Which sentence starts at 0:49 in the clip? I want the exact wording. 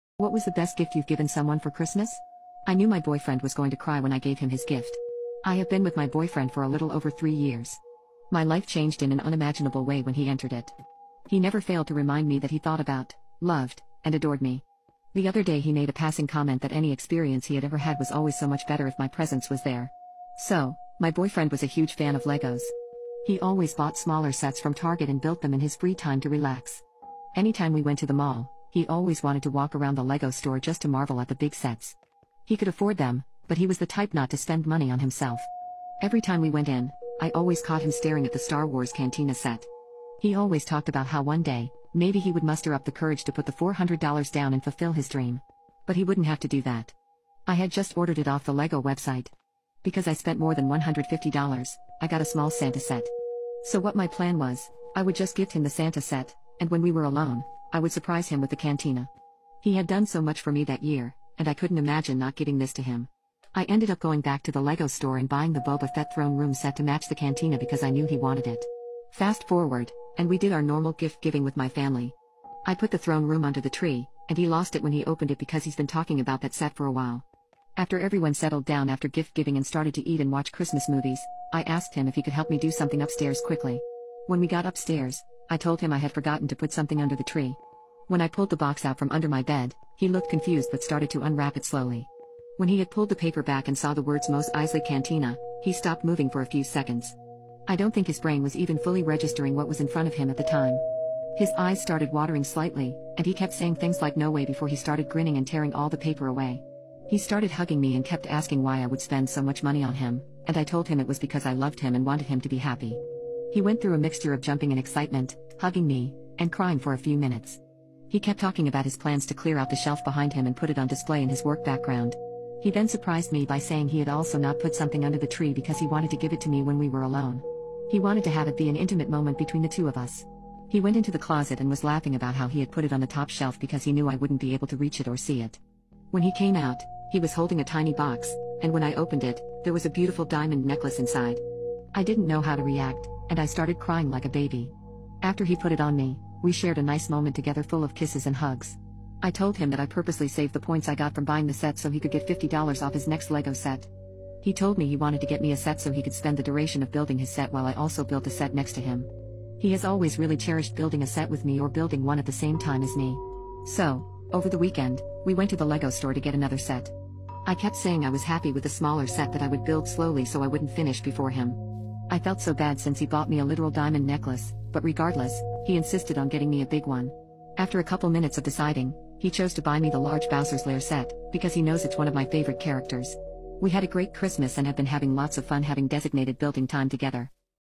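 Because I spent more than $150, I got a small Santa set.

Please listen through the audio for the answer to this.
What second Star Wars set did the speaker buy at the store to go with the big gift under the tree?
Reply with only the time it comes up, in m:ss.
1:05.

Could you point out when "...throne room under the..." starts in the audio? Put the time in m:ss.
1:12.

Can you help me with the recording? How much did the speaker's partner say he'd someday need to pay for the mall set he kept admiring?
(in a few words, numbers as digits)
$400.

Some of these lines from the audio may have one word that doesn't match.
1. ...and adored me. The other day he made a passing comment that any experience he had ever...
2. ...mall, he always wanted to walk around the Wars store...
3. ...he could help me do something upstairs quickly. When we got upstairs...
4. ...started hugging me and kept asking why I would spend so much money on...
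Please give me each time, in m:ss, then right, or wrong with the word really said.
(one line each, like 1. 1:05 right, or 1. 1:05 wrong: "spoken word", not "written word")
1. 0:14 right
2. 0:28 wrong: "Lego", not "Wars"
3. 1:22 right
4. 1:47 right.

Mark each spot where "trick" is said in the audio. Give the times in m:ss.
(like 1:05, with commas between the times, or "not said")
not said.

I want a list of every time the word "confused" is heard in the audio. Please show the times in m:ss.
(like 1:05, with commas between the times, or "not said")
1:30.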